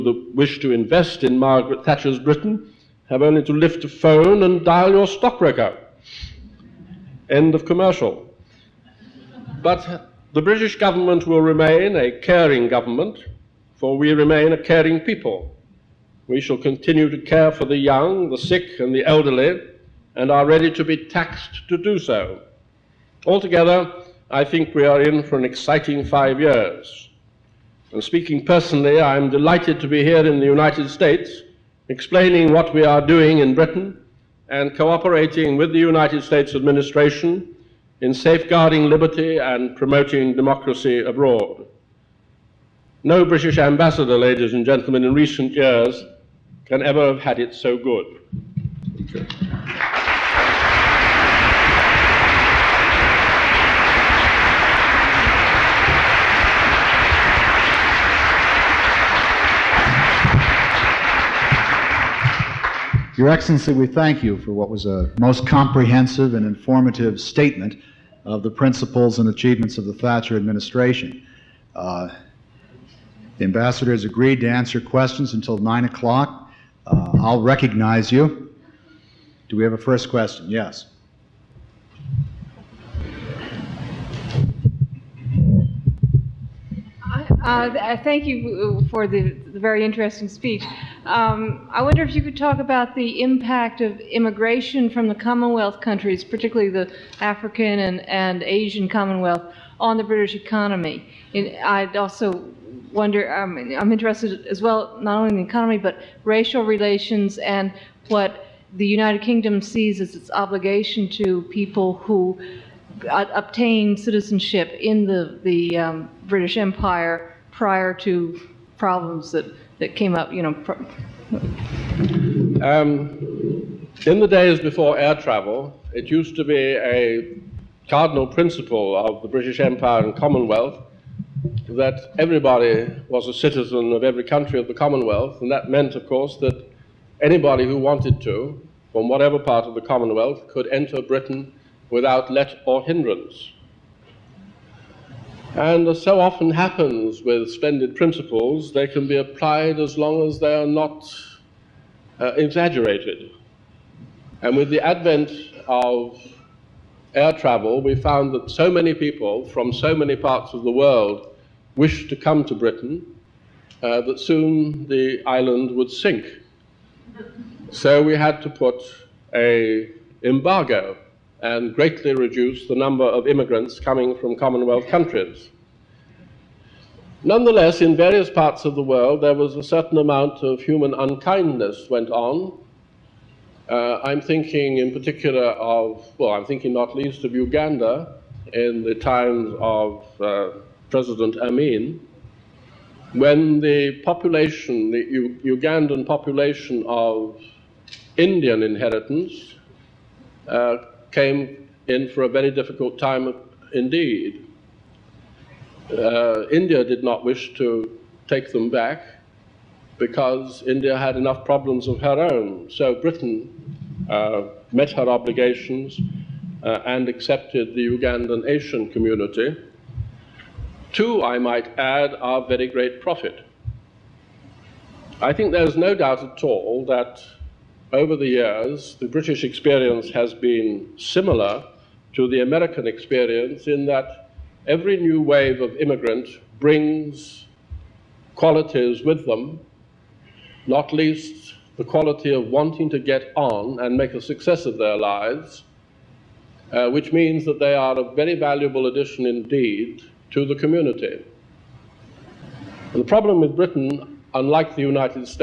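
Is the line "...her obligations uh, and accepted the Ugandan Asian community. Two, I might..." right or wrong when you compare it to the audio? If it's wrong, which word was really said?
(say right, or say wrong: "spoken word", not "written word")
right.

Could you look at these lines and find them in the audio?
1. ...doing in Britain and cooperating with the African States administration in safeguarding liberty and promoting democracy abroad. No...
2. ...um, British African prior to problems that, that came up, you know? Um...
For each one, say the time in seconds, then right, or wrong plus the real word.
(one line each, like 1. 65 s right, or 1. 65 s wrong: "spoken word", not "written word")
1. 33 s wrong: "United", not "African"
2. 115 s wrong: "Empire", not "African".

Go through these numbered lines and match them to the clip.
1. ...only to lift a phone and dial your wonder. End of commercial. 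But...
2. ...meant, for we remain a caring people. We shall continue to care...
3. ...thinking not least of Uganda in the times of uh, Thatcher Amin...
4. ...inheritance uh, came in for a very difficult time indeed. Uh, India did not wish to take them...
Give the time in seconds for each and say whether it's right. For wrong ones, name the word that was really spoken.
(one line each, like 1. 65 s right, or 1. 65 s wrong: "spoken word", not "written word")
1. 3 s wrong: "stockbroker", not "wonder"
2. 12 s wrong: "government", not "meant"
3. 186 s wrong: "President", not "Thatcher"
4. 198 s right.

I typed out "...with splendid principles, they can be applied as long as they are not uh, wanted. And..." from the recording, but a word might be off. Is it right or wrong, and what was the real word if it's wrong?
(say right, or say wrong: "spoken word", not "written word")
wrong: "exaggerated", not "wanted".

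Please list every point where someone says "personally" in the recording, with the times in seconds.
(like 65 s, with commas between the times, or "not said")
28 s.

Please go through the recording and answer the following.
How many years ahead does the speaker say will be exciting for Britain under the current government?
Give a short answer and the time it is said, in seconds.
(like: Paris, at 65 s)
5, at 26 s.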